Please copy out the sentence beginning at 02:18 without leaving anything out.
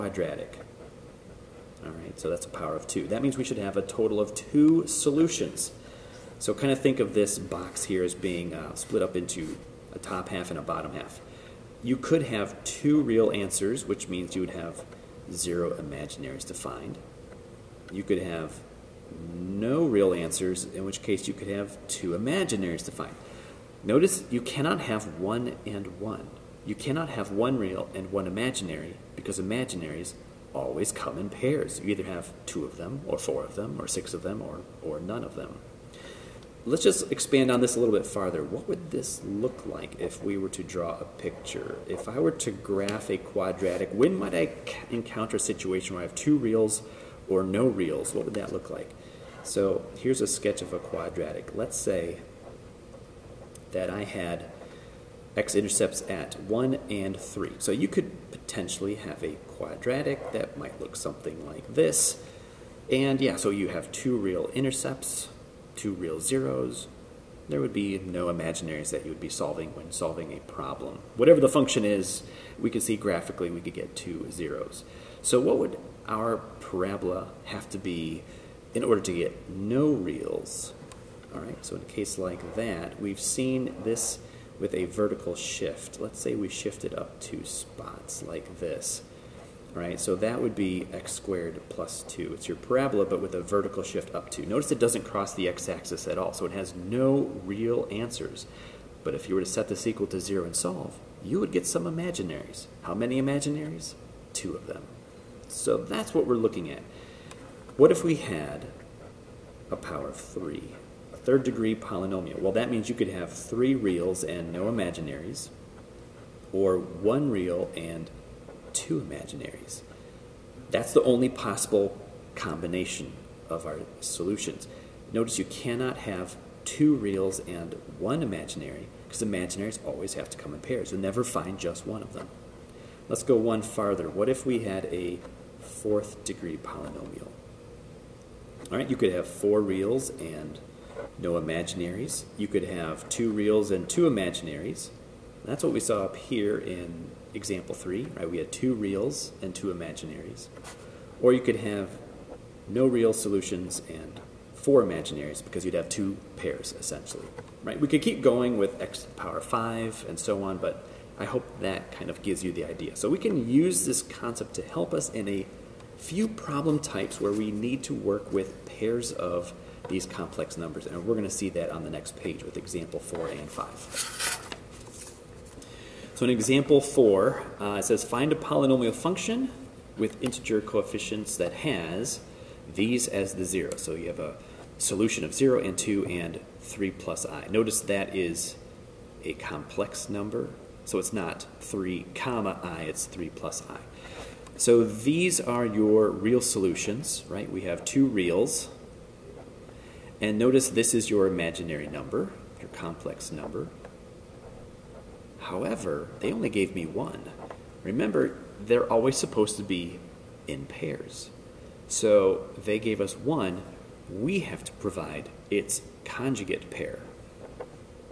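All right, you could have four reals and no imaginaries.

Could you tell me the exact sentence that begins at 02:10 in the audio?
You'll never find just one of them.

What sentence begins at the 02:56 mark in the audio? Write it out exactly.
So in example 4, uh, it says find a polynomial function with integer coefficients that has these as the 0.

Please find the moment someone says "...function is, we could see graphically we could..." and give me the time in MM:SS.
01:11.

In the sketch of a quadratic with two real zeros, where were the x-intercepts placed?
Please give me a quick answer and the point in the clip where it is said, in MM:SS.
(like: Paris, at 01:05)
1 and 3, at 00:56.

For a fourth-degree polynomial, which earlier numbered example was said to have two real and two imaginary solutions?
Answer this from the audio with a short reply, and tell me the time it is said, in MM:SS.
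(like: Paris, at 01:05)
Example 3, at 02:27.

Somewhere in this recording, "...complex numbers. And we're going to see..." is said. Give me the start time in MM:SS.
02:50.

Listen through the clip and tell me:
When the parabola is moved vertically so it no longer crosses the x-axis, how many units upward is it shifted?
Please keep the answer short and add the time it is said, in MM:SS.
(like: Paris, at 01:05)
2, at 01:26.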